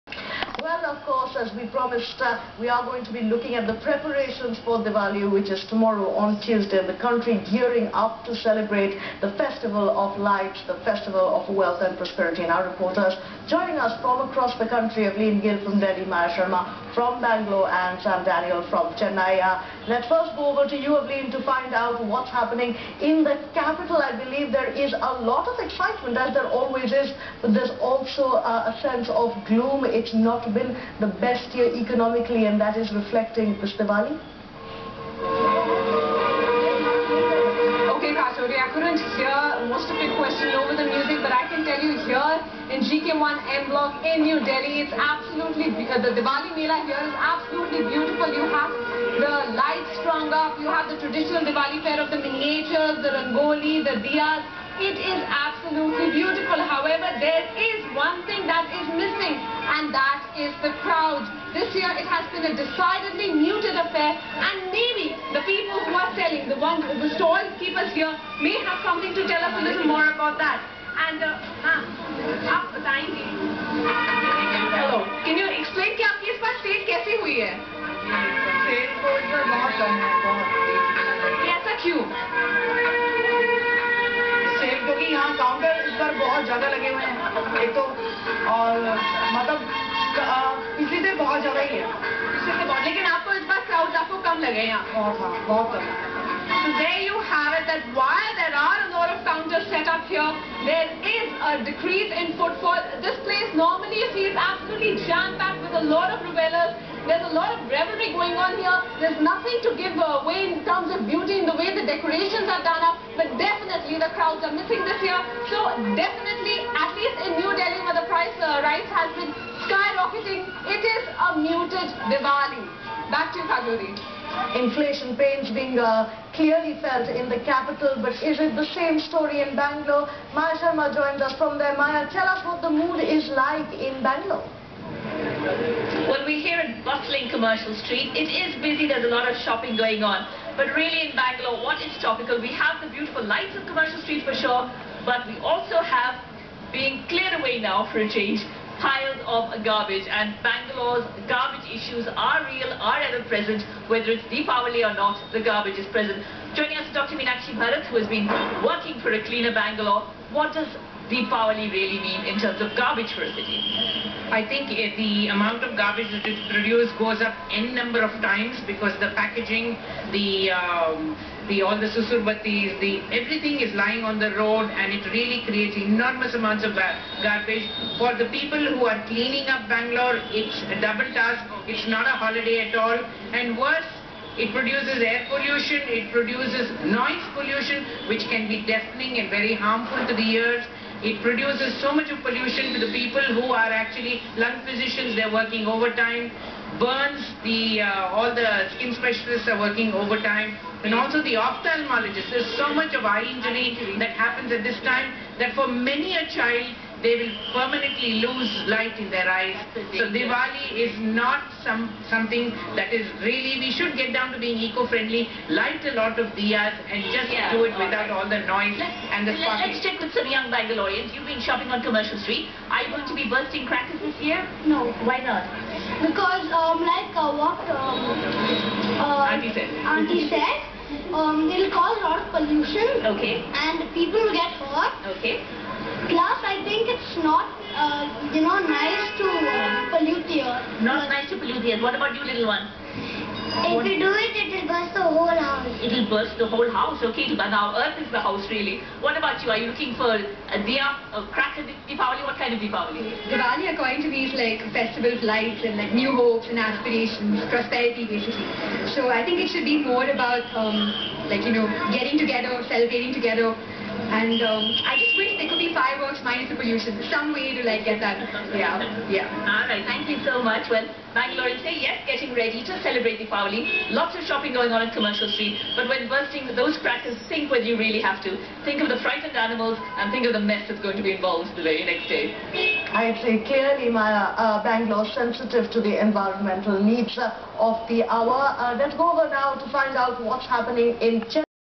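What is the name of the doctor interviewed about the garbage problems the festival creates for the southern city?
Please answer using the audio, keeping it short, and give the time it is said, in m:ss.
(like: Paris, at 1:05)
Meenakshi Bharath, at 2:37.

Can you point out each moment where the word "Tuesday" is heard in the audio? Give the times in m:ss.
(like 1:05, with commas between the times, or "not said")
0:06.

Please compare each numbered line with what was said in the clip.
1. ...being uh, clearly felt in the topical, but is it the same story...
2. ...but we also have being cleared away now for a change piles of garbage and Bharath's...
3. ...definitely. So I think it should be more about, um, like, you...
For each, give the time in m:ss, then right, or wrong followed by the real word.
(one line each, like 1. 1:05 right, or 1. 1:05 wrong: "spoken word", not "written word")
1. 2:05 wrong: "capital", not "topical"
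2. 2:25 wrong: "Bangalore", not "Bharath"
3. 4:18 wrong: "basically", not "definitely".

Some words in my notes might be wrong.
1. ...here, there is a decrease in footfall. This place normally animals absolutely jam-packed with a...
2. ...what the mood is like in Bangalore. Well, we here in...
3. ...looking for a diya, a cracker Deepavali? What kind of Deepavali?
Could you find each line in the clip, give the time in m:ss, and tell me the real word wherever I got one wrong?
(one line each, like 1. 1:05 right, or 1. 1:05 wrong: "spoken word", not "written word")
1. 1:40 wrong: "feels", not "animals"
2. 2:12 right
3. 4:09 right.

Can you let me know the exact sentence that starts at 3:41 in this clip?
You've been shopping on Commercial Street.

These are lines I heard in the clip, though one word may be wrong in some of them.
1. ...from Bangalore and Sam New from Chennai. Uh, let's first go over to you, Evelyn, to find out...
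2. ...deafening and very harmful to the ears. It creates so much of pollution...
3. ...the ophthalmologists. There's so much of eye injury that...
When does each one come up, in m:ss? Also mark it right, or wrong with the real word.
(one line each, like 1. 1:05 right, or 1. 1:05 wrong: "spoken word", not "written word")
1. 0:16 wrong: "Daniel", not "New"
2. 3:08 wrong: "produces", not "creates"
3. 3:21 right.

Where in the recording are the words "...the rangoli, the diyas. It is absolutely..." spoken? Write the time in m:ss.
0:53.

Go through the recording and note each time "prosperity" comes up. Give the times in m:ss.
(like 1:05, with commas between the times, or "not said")
0:11, 4:17.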